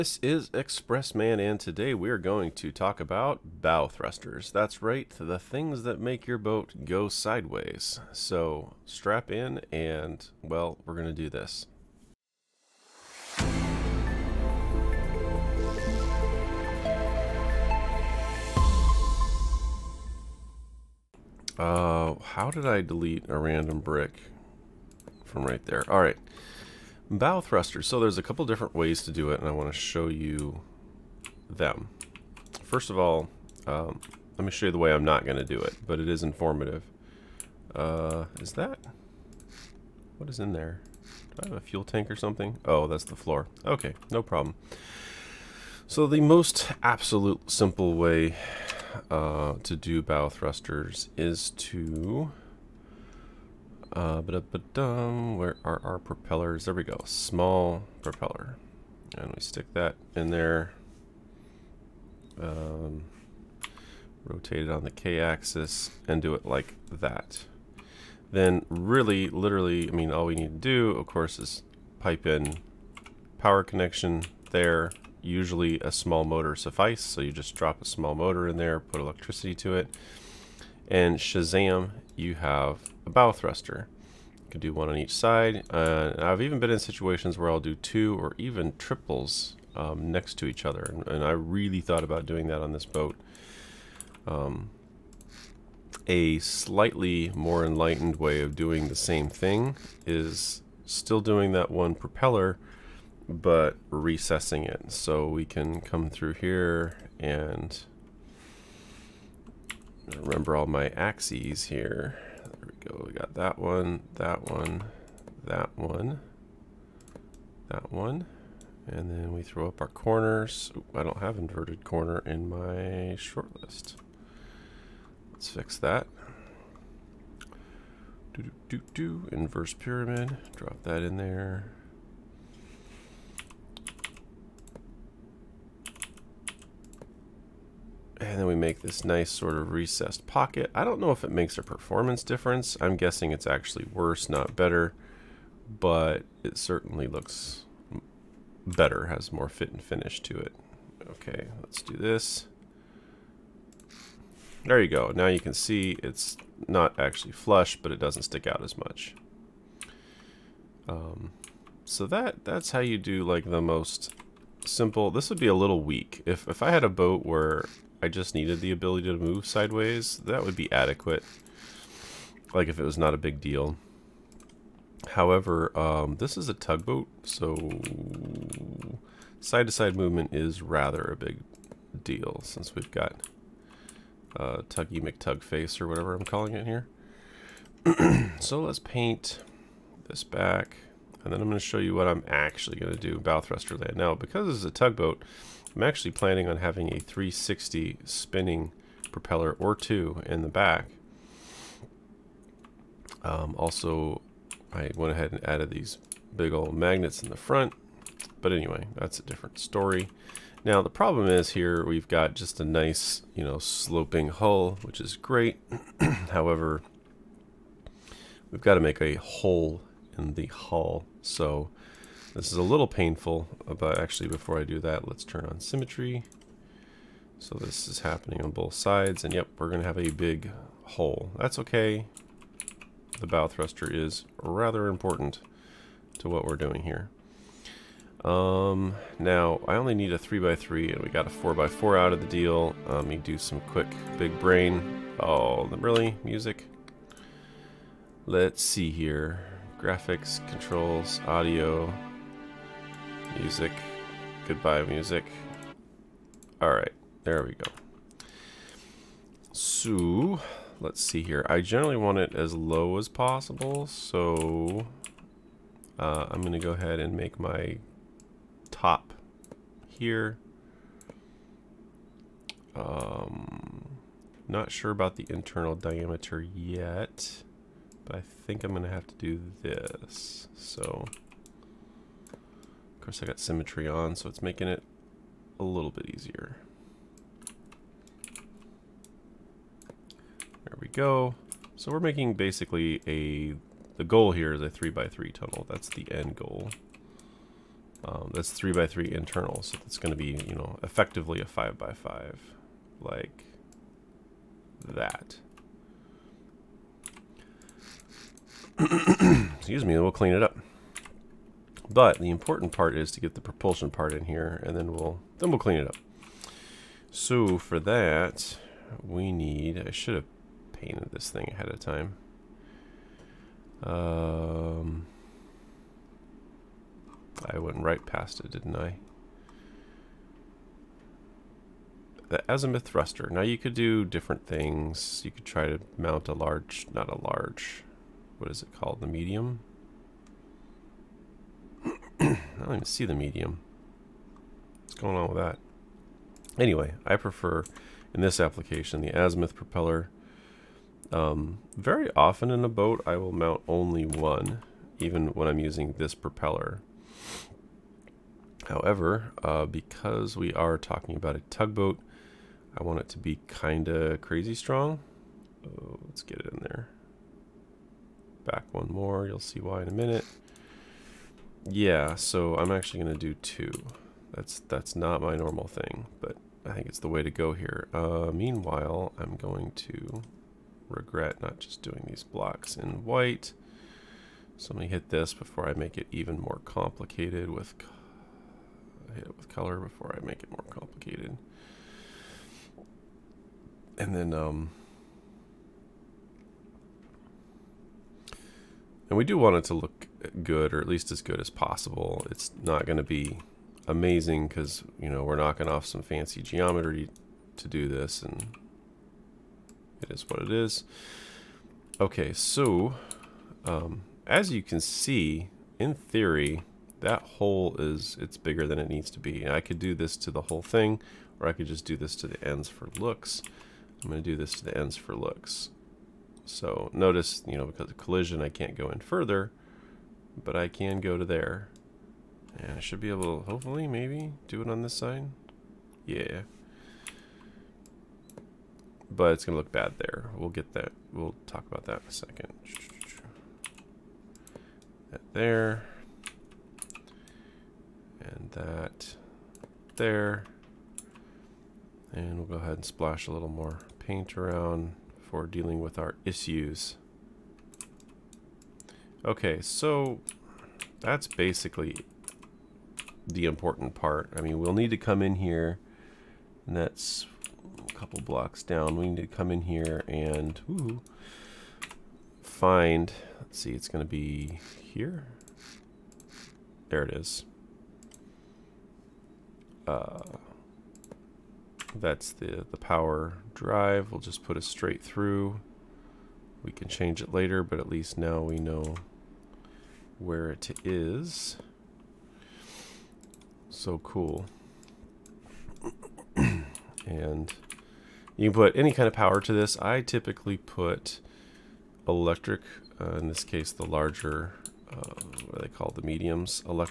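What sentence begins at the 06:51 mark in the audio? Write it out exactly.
Okay, so um, as you can see, in theory, that hole is it's bigger than it needs to be.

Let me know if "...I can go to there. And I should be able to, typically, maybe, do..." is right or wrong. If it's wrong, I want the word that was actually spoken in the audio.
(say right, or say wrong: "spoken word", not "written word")
wrong: "hopefully", not "typically".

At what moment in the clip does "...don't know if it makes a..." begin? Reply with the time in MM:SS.
02:20.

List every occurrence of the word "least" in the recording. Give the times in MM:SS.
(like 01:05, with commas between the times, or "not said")
06:40, 08:07.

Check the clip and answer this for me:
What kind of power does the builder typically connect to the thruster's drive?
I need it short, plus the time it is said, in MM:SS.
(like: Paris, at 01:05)
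Electric, at 08:22.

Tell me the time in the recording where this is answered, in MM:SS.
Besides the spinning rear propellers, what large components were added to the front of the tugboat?
03:26.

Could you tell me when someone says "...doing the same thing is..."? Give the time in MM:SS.
01:38.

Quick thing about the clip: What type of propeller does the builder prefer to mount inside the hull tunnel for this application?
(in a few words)
Azimuth propeller.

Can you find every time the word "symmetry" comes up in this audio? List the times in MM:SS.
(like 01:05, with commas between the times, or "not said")
03:45, 04:43.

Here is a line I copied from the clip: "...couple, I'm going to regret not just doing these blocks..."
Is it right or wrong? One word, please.
wrong.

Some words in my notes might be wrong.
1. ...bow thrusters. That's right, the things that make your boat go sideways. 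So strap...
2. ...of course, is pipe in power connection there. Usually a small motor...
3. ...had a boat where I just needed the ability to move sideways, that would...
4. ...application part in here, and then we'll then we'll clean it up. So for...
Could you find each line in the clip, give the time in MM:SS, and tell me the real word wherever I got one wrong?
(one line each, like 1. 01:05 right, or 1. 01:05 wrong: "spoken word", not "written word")
1. 00:03 right
2. 01:10 right
3. 02:46 right
4. 05:13 wrong: "propulsion", not "application".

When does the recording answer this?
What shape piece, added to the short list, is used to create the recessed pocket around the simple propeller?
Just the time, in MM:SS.
02:09.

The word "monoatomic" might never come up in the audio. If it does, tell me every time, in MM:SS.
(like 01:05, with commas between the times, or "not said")
not said.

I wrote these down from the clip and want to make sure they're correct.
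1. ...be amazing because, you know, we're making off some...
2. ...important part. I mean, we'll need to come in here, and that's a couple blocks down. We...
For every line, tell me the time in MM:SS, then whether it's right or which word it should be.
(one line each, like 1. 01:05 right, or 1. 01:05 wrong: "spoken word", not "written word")
1. 06:43 wrong: "knocking", not "making"
2. 07:43 right.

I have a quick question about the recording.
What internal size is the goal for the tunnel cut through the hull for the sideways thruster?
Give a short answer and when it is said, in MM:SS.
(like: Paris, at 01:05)
3x3, at 04:54.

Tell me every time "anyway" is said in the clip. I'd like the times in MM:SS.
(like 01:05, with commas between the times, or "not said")
03:28, 05:46.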